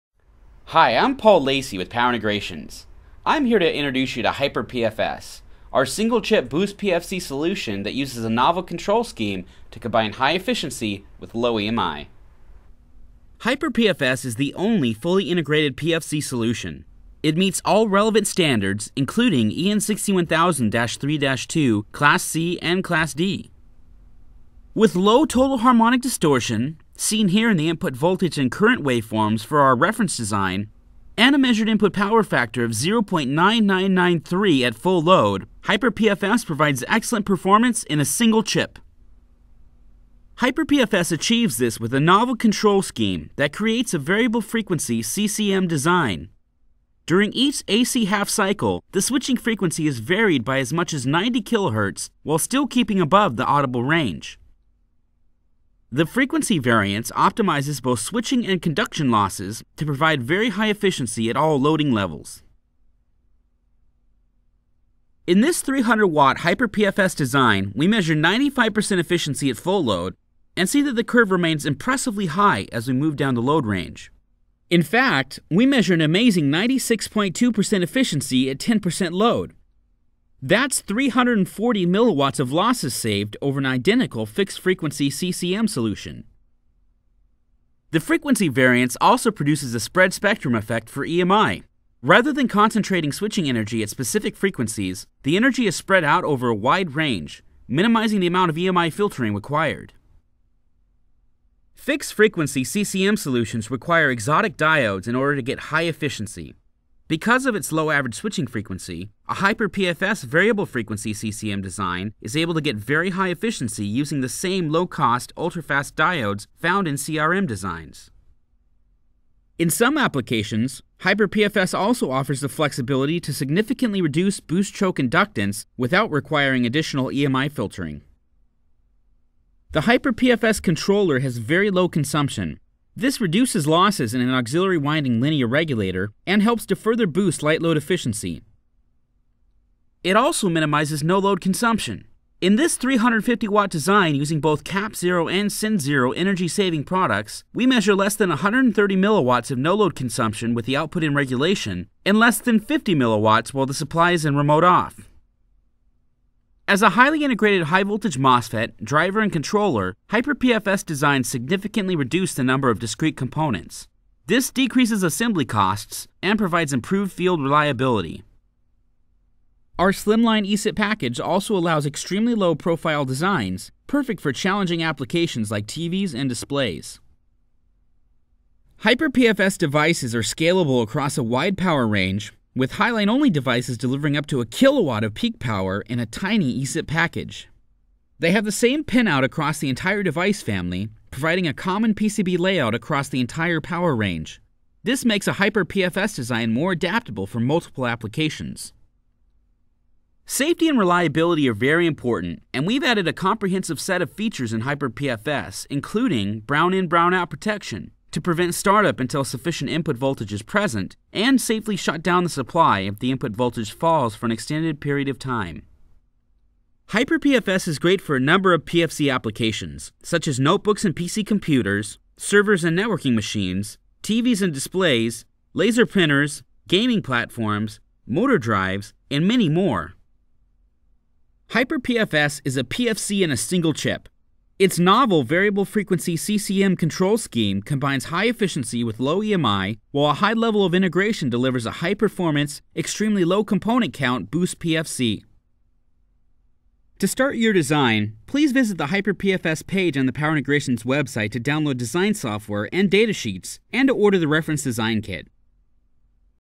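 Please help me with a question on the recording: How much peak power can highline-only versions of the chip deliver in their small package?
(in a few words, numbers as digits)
a kilowatt.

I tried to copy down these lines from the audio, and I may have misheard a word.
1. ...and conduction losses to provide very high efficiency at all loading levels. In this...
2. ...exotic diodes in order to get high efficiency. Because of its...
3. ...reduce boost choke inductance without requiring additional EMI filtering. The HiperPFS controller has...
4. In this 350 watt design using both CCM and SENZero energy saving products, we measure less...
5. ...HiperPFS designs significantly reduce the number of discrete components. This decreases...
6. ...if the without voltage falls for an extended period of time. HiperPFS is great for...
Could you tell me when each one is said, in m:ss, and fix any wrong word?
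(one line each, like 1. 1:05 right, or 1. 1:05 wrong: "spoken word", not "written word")
1. 0:58 right
2. 1:44 right
3. 2:04 right
4. 2:22 wrong: "CAPZero", not "CCM"
5. 2:40 right
6. 3:32 wrong: "input", not "without".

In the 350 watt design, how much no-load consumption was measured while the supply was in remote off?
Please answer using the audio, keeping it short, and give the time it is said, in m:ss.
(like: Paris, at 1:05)
less than 50 milliwatts, at 2:32.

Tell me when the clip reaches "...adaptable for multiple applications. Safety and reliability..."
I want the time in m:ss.
3:16.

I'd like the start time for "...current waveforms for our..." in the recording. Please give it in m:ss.
0:28.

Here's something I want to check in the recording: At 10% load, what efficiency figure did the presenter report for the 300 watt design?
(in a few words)
96.2%.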